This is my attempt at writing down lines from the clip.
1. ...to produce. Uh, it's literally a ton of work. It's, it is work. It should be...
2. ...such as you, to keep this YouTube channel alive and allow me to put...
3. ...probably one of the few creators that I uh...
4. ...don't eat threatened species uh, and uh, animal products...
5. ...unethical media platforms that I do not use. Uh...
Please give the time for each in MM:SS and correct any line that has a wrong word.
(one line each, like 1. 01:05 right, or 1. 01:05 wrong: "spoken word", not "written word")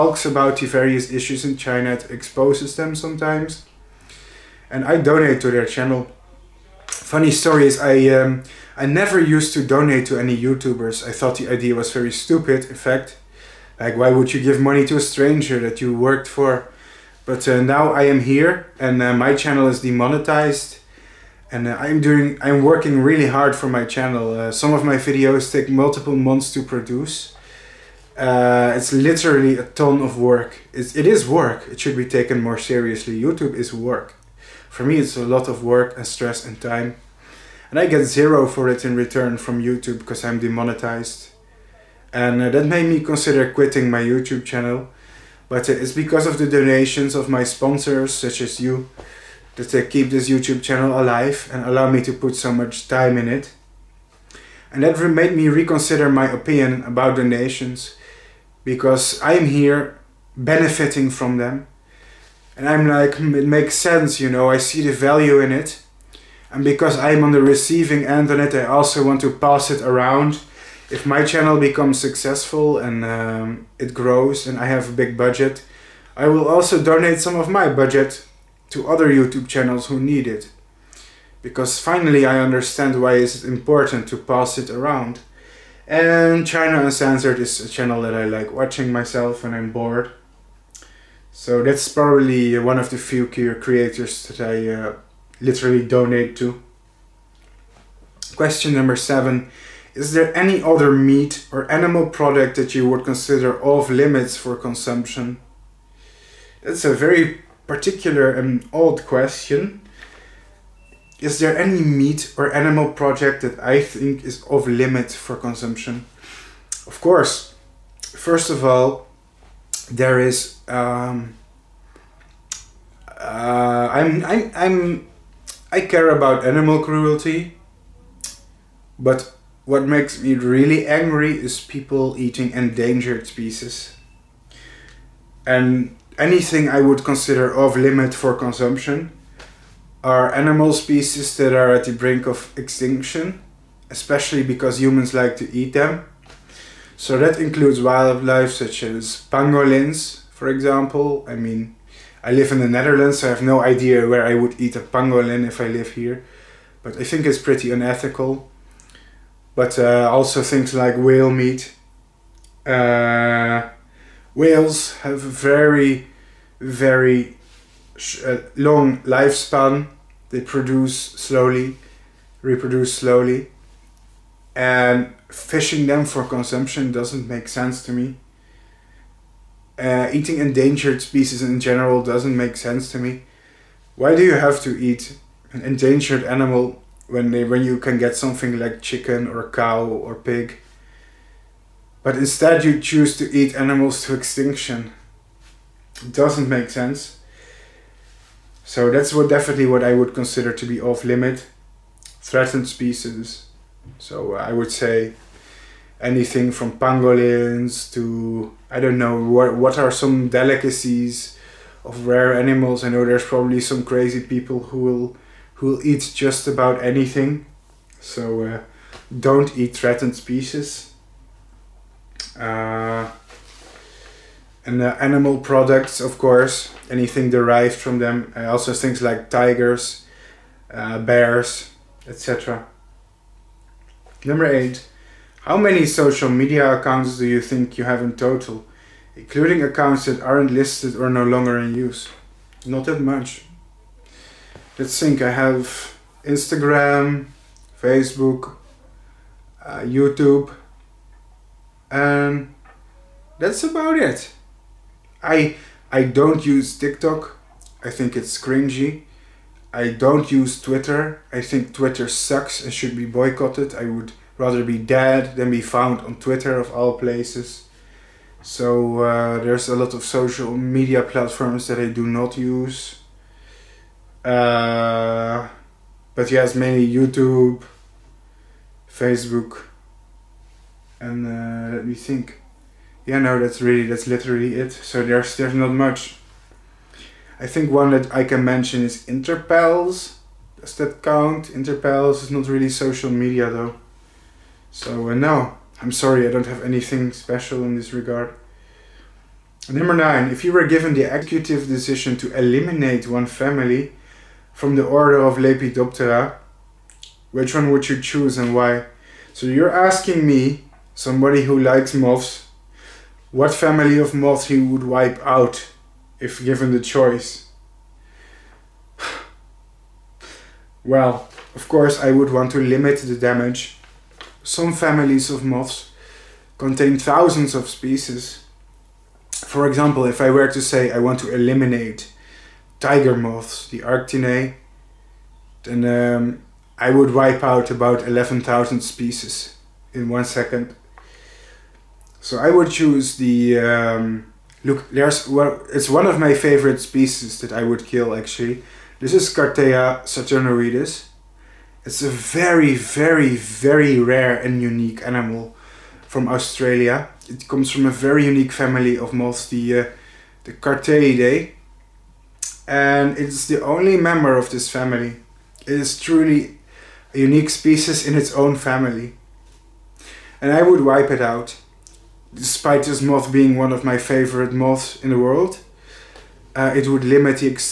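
1. 00:26 right
2. 00:48 right
3. 01:31 right
4. 03:39 right
5. 04:30 wrong: "social", not "unethical".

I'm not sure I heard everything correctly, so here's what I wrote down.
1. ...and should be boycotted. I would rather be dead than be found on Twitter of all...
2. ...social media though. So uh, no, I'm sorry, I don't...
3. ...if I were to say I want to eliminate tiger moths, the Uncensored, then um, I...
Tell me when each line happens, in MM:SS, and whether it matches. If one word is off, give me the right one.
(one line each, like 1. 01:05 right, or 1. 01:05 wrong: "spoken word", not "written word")
1. 04:22 right
2. 04:52 right
3. 05:30 wrong: "Arctiinae", not "Uncensored".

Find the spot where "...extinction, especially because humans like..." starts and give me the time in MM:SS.
02:22.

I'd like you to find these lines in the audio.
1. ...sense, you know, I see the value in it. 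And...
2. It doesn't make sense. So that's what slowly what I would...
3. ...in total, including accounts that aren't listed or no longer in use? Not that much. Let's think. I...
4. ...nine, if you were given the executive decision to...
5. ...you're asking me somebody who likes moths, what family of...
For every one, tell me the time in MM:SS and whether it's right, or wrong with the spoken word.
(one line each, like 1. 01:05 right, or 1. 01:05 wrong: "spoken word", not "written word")
1. 01:03 right
2. 03:16 wrong: "definitely", not "slowly"
3. 03:58 right
4. 04:59 right
5. 05:09 right.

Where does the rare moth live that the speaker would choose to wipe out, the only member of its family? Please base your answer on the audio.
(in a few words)
Australia.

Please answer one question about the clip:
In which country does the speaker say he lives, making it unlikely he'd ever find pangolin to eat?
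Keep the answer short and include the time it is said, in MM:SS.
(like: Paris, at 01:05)
The Netherlands, at 02:32.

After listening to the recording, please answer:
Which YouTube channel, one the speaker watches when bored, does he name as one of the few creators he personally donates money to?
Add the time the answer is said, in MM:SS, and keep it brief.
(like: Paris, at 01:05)
China Uncensored, at 01:26.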